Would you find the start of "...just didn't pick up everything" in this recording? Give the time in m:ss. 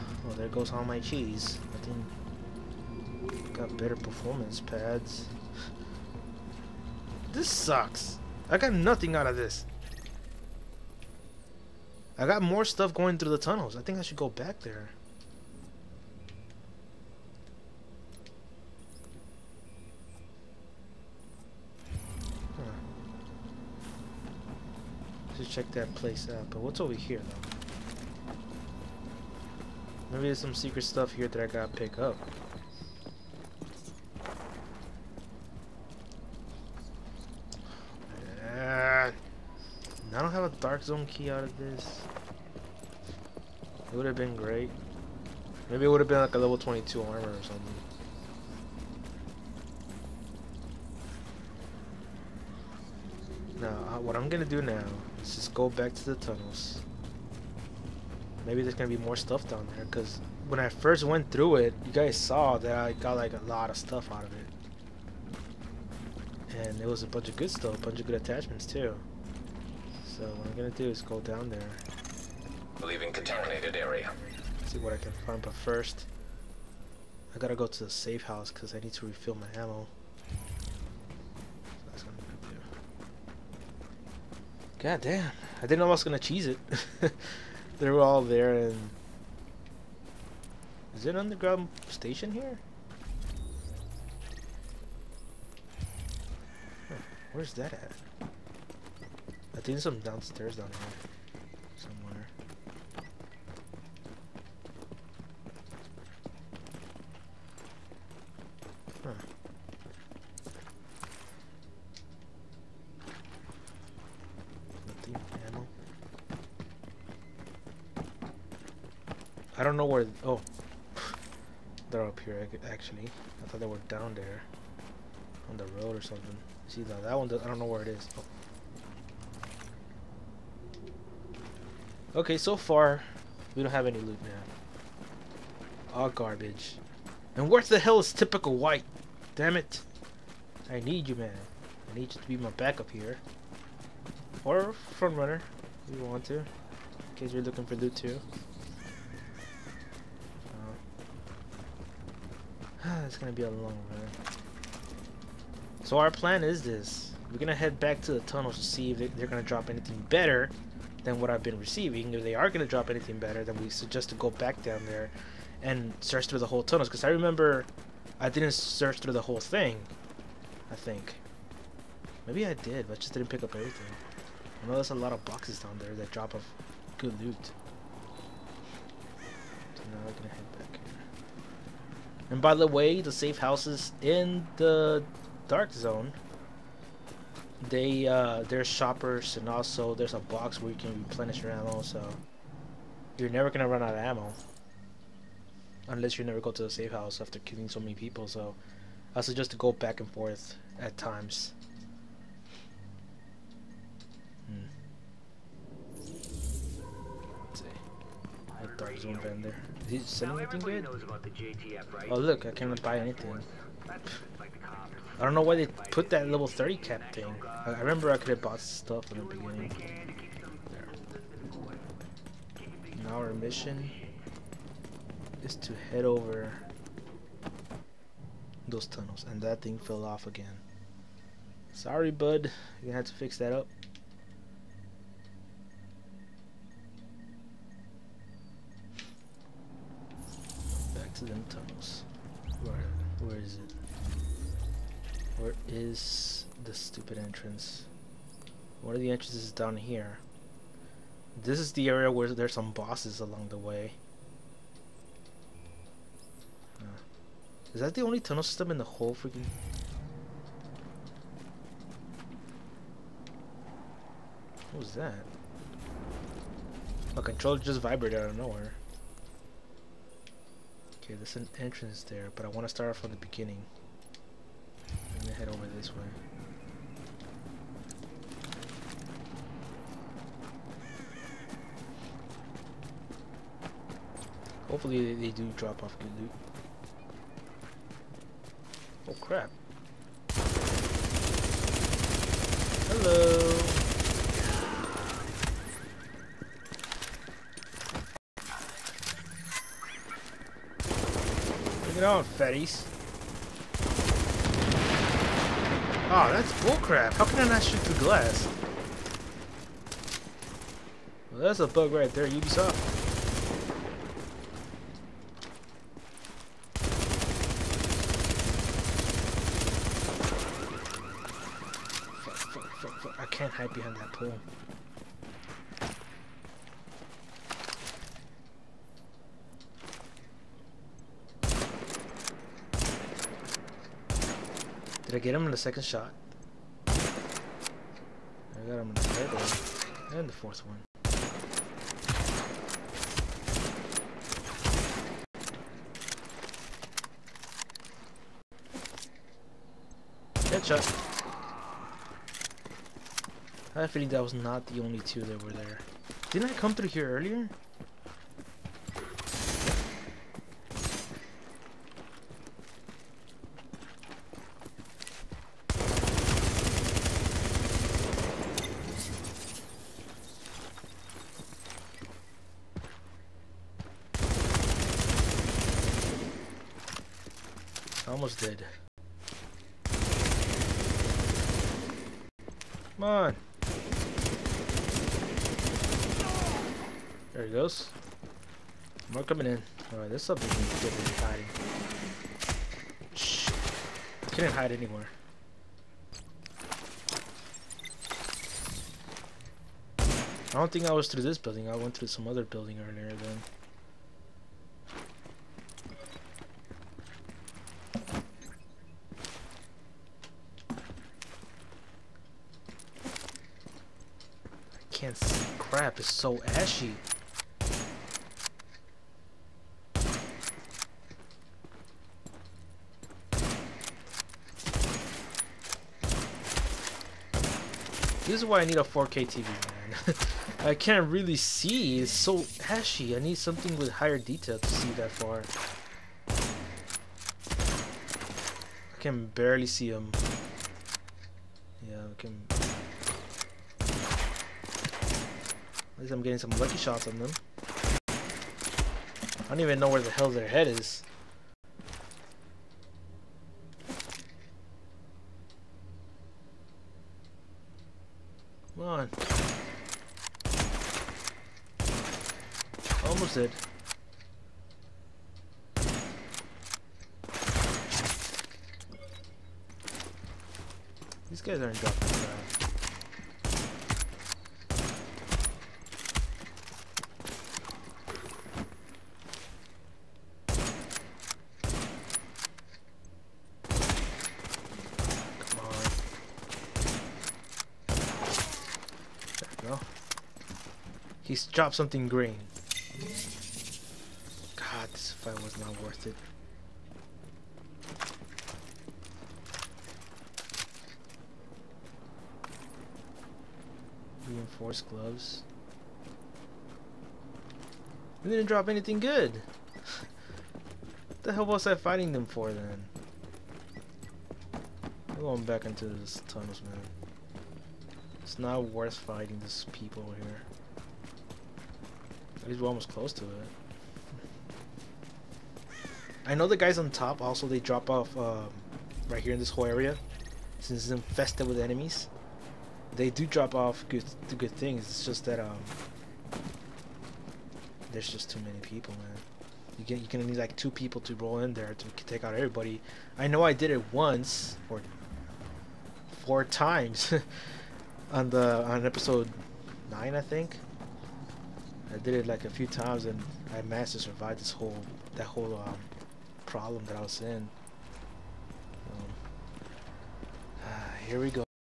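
2:52.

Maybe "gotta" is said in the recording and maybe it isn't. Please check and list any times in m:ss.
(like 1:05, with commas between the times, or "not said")
0:31, 1:17.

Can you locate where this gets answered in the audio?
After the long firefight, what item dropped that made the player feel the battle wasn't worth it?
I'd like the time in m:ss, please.
8:24.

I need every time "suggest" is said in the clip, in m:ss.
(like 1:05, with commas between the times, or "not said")
2:43, 3:19.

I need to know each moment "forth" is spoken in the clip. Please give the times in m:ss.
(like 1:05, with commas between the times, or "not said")
3:20.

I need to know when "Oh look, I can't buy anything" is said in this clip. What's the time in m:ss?
3:32.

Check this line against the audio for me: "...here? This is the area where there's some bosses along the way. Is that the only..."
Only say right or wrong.
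right.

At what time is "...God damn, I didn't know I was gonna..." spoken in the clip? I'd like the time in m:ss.
1:24.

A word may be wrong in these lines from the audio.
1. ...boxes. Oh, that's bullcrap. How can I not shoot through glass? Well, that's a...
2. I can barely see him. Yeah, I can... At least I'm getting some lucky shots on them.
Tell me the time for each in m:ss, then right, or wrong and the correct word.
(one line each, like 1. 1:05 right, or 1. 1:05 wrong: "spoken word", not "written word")
1. 5:02 wrong: "fatties", not "boxes"
2. 7:18 right.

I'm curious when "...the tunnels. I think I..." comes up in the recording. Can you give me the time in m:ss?
0:13.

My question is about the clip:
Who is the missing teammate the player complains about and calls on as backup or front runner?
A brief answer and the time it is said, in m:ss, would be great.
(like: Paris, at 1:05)
typical white, at 2:18.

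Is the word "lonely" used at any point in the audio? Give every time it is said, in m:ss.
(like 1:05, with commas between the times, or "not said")
not said.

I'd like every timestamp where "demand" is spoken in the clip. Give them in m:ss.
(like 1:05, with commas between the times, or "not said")
not said.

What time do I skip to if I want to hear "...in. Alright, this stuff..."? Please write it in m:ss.
6:29.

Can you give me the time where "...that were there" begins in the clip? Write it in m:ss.
5:55.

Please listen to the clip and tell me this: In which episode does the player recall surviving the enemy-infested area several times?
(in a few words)
9.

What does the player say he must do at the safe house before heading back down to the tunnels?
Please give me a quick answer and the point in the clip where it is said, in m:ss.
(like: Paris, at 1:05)
refill my ammo, at 1:19.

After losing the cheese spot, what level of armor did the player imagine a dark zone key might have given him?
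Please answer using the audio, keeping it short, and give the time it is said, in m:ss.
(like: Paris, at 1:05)
22, at 0:46.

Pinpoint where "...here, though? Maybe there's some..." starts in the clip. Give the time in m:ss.
0:26.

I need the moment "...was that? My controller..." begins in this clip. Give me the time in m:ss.
4:24.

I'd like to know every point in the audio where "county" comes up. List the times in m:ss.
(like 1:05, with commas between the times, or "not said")
not said.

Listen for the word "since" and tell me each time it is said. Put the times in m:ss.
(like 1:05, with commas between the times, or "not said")
8:50.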